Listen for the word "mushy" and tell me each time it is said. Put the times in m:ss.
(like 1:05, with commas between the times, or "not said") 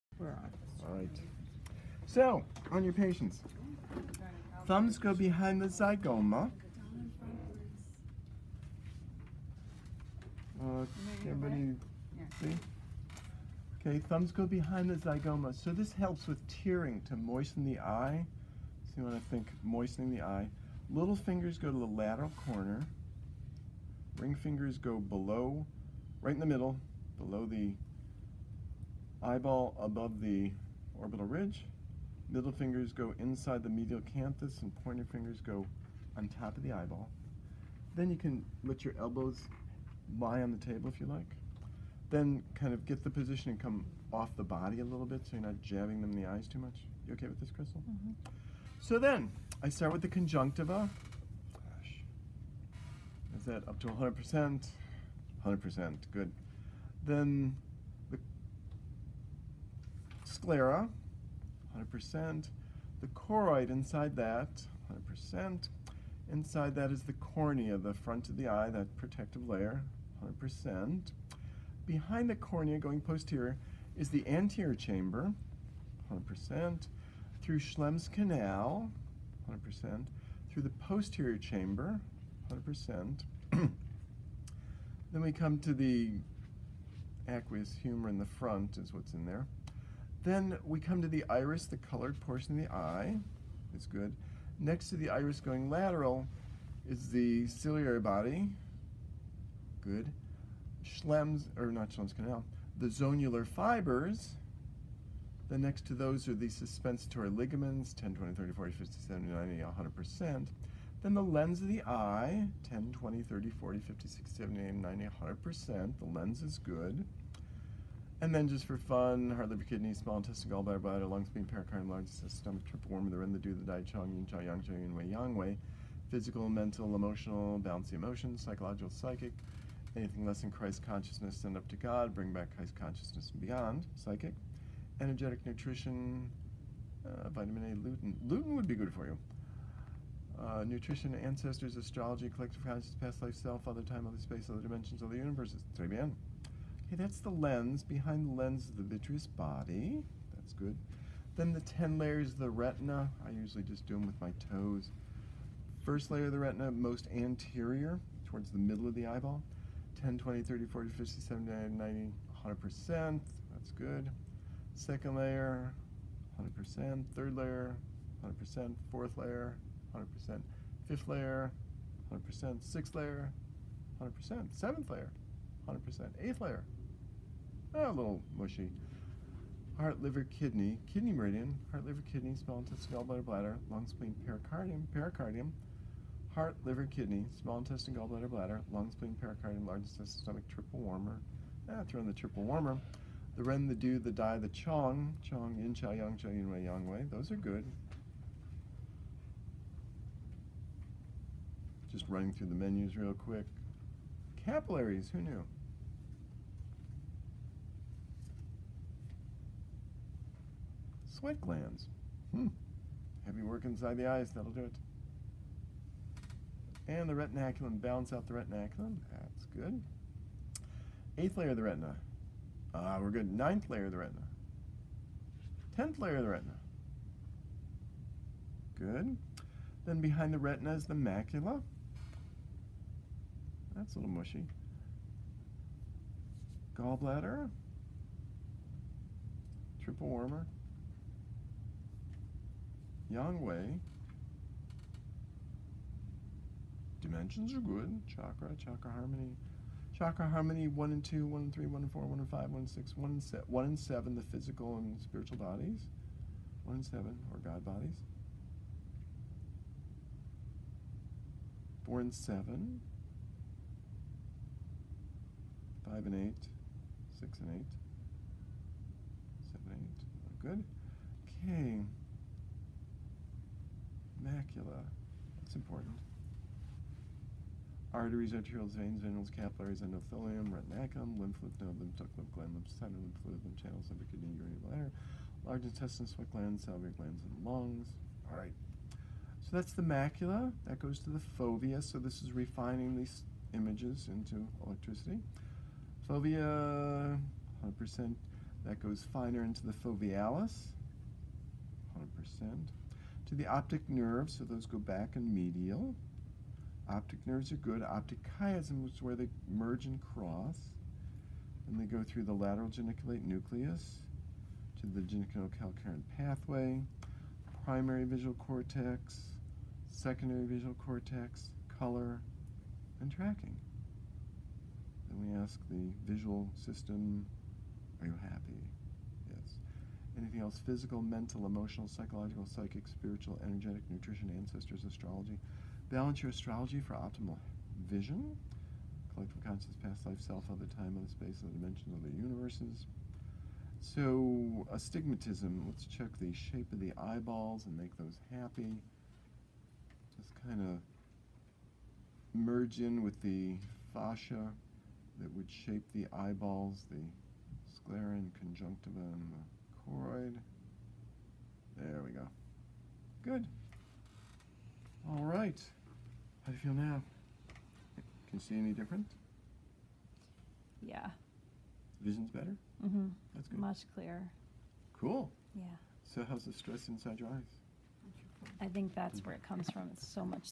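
2:58, 3:54.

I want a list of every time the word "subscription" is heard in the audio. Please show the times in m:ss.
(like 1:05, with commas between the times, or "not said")
not said.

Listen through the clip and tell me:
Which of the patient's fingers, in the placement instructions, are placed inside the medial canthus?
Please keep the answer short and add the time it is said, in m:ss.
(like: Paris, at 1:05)
Middle fingers, at 0:32.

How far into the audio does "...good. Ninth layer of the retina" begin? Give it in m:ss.
3:43.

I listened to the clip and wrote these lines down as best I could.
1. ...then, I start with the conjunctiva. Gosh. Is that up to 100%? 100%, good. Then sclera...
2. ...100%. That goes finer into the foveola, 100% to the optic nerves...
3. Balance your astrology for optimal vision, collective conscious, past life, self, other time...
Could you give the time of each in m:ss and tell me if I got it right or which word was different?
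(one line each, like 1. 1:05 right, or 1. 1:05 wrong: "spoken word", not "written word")
1. 0:48 right
2. 4:57 right
3. 5:35 right.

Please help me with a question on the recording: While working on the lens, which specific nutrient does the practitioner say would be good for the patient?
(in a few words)
Lutein.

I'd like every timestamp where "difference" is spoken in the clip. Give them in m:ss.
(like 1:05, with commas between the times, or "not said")
6:08.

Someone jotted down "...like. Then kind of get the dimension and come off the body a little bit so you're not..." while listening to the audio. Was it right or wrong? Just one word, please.
wrong.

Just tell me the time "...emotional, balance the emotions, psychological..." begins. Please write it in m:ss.
2:06.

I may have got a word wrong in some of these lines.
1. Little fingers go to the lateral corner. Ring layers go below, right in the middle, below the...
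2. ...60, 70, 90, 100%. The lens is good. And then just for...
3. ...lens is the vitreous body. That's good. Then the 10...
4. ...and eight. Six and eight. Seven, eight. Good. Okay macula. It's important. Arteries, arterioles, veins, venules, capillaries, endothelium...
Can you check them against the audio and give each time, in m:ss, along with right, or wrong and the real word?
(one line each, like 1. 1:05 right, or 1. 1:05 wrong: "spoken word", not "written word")
1. 0:20 wrong: "fingers", not "layers"
2. 1:54 right
3. 2:28 right
4. 4:26 right.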